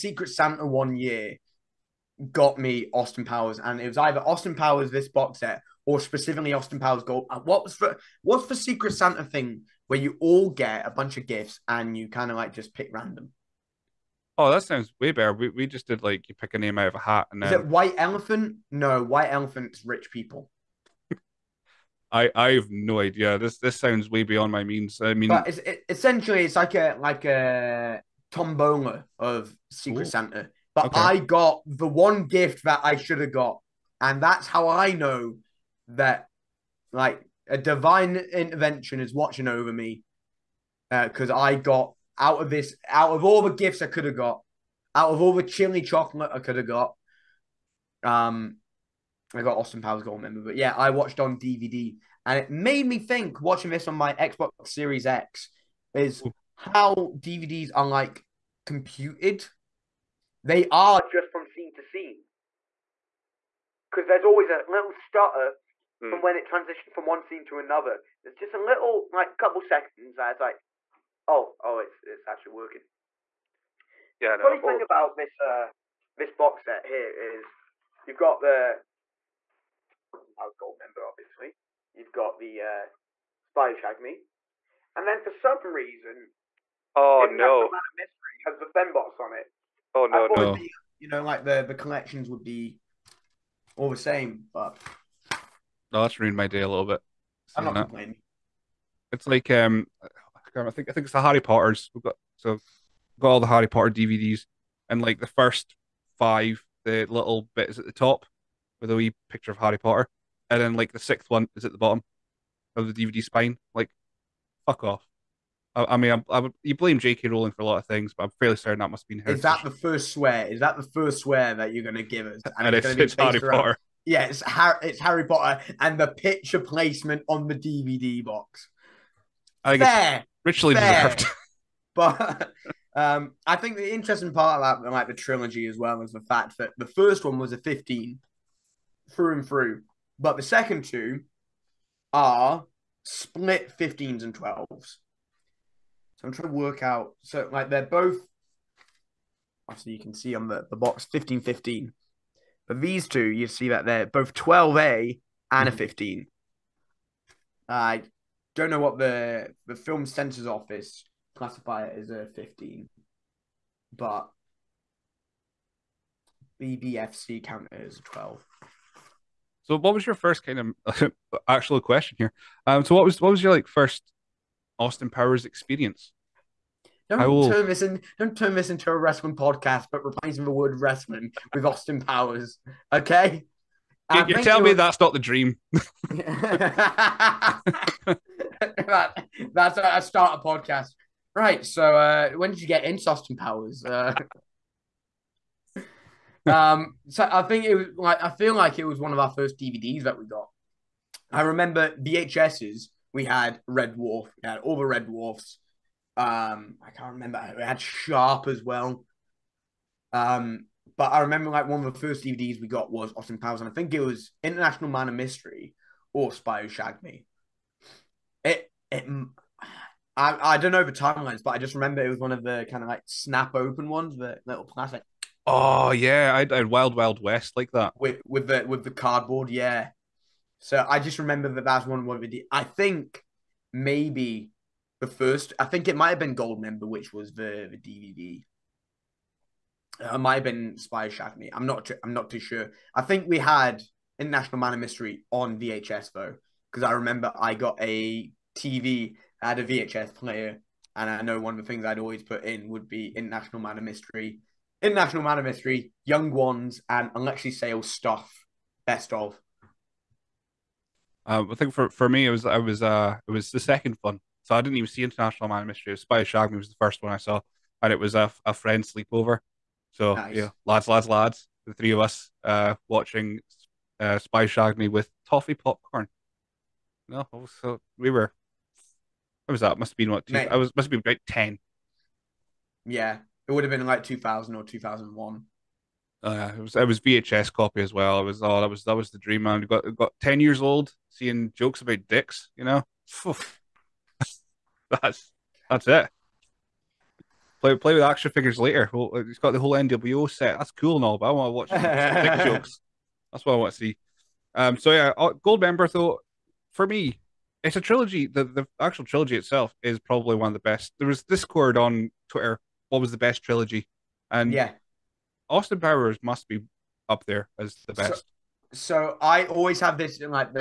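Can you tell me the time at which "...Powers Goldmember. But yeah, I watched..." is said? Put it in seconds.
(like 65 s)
49 s.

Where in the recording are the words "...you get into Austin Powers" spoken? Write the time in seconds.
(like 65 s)
192 s.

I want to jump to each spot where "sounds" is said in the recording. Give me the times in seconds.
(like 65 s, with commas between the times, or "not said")
14 s, 23 s.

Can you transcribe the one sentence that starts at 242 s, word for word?
I think we had International Man of Mystery on VHS though, because I remember I got a TV.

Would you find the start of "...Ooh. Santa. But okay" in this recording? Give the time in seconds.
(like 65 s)
30 s.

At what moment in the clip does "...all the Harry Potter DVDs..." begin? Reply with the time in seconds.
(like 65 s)
103 s.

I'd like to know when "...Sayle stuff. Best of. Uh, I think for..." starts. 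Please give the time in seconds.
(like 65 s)
257 s.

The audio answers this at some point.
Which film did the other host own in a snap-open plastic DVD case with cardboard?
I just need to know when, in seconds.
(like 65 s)
226 s.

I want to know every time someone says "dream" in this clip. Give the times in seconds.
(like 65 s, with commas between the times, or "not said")
185 s, 289 s.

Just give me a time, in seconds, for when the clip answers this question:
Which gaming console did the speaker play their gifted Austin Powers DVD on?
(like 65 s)
54 s.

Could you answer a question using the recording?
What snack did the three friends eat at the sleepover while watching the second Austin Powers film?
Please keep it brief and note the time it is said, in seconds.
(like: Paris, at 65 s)
Toffee popcorn, at 275 s.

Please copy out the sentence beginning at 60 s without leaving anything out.
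They are just from scene to scene.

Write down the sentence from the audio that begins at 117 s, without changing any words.
Rowling for a lot of things, but I'm fairly certain that must be her.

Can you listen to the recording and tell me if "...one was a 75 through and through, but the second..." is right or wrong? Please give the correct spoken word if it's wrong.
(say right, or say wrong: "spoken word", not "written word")
wrong: "15", not "75".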